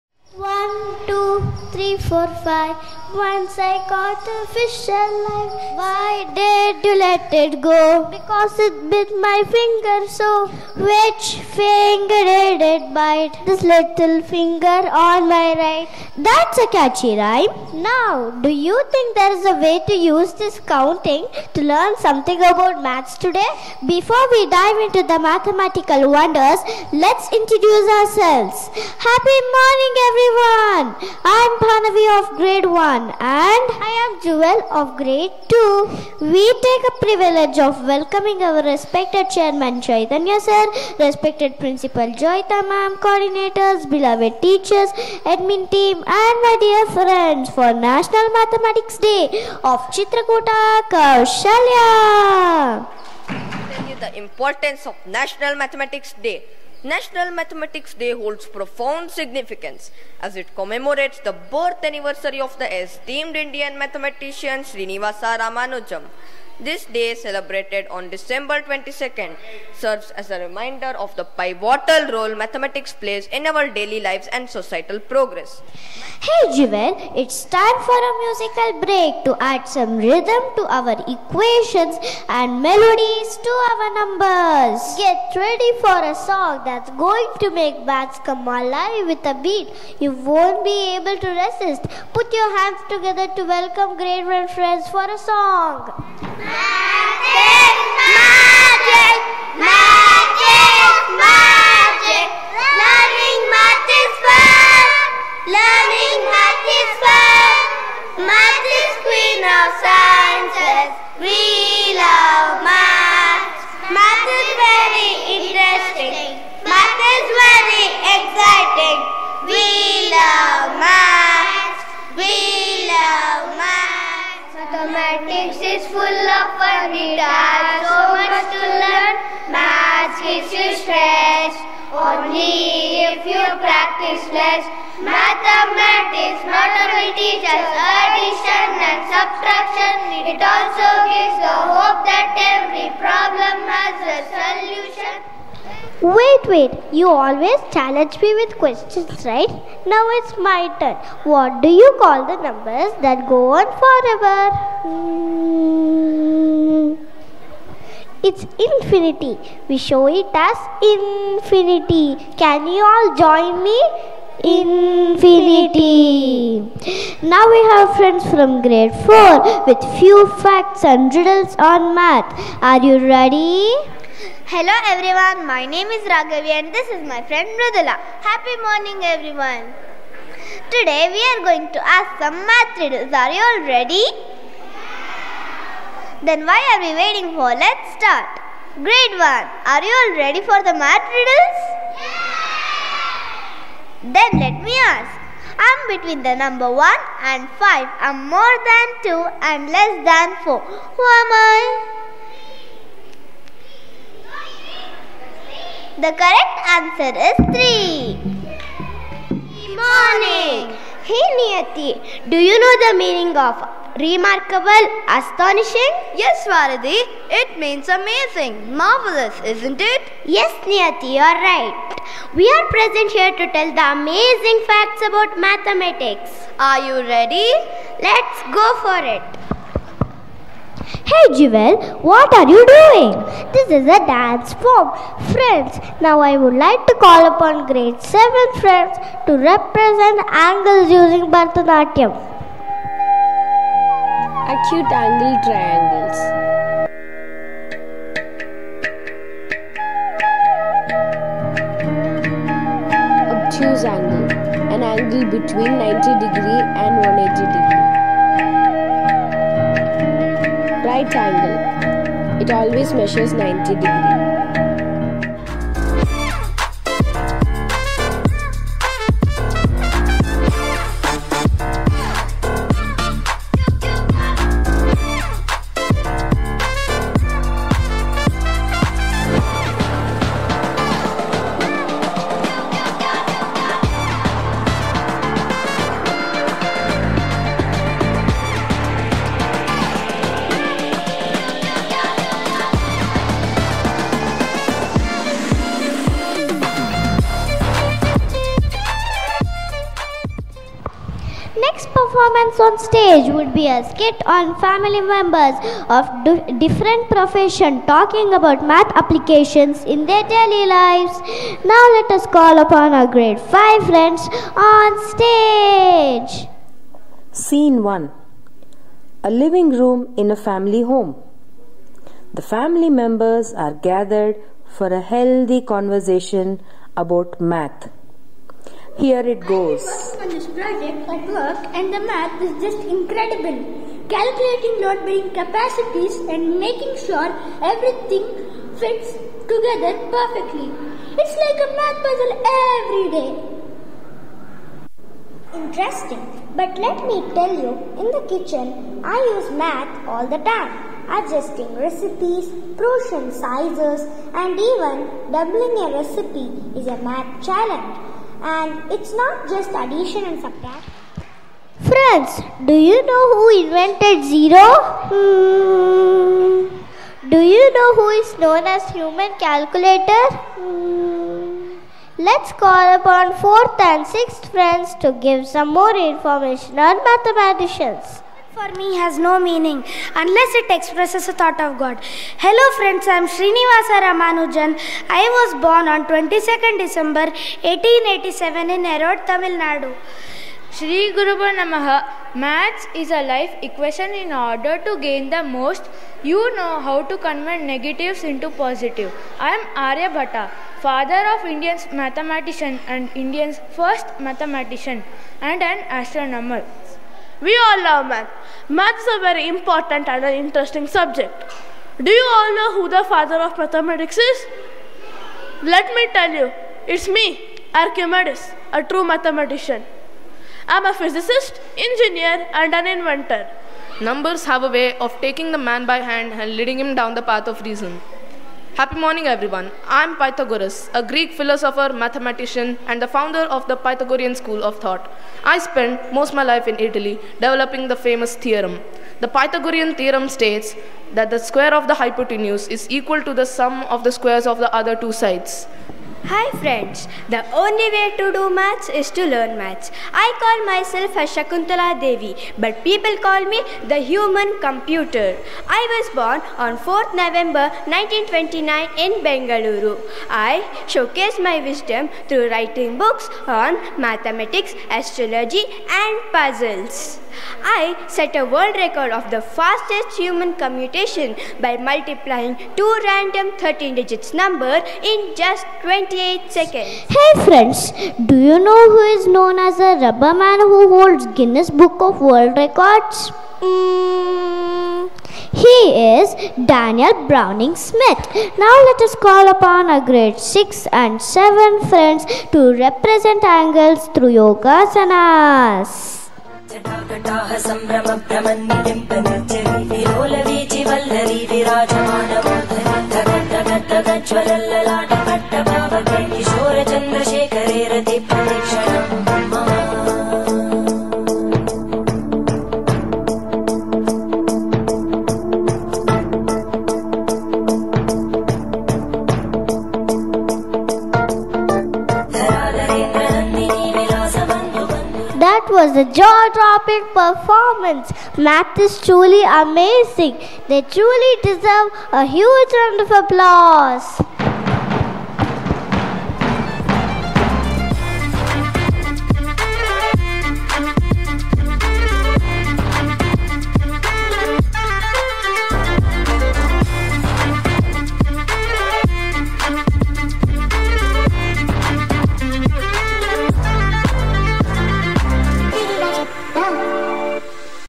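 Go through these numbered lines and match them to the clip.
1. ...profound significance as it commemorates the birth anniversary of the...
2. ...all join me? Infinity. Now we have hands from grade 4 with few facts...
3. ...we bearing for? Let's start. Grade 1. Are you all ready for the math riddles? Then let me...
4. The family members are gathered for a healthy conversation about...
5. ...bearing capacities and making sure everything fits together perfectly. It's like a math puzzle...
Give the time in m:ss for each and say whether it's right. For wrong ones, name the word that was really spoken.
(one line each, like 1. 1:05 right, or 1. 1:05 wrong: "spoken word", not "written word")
1. 0:58 right
2. 2:42 wrong: "friends", not "hands"
3. 3:06 wrong: "waiting", not "bearing"
4. 5:22 right
5. 5:35 right.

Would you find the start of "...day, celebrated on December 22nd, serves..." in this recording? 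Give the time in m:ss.
1:06.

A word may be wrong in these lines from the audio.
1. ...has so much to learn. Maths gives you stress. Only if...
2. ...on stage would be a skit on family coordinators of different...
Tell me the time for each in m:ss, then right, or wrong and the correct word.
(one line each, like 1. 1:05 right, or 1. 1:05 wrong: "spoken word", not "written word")
1. 2:07 right
2. 5:02 wrong: "members", not "coordinators".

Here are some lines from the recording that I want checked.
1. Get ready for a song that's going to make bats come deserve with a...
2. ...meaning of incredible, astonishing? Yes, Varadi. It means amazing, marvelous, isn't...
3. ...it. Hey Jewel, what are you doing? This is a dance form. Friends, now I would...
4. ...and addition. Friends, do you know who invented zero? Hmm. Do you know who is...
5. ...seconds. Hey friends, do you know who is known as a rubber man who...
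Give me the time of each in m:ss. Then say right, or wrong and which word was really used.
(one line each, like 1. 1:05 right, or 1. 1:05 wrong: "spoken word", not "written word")
1. 1:25 wrong: "alive", not "deserve"
2. 3:33 wrong: "remarkable", not "incredible"
3. 3:49 right
4. 6:00 wrong: "subtraction", not "addition"
5. 7:56 right.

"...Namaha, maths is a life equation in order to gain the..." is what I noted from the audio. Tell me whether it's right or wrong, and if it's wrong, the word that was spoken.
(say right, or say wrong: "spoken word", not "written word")
right.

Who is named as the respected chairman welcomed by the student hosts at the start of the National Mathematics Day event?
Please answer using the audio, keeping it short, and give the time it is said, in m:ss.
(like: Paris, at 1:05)
Chaitanya, at 0:39.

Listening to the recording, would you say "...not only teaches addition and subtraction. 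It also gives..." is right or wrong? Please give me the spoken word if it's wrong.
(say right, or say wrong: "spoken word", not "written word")
right.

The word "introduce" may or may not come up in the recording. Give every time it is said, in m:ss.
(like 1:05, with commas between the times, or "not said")
0:27.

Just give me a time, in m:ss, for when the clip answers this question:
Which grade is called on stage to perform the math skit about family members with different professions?
5:13.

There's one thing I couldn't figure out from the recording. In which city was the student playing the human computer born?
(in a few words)
Bengaluru.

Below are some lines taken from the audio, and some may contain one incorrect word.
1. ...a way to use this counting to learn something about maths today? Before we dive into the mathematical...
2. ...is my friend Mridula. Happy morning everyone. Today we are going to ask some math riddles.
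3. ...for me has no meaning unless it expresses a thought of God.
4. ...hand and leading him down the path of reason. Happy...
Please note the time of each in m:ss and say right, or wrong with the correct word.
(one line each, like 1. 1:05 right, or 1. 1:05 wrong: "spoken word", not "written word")
1. 0:19 right
2. 2:56 right
3. 6:18 right
4. 7:05 right.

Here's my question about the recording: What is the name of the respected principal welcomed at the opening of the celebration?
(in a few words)
Joyita.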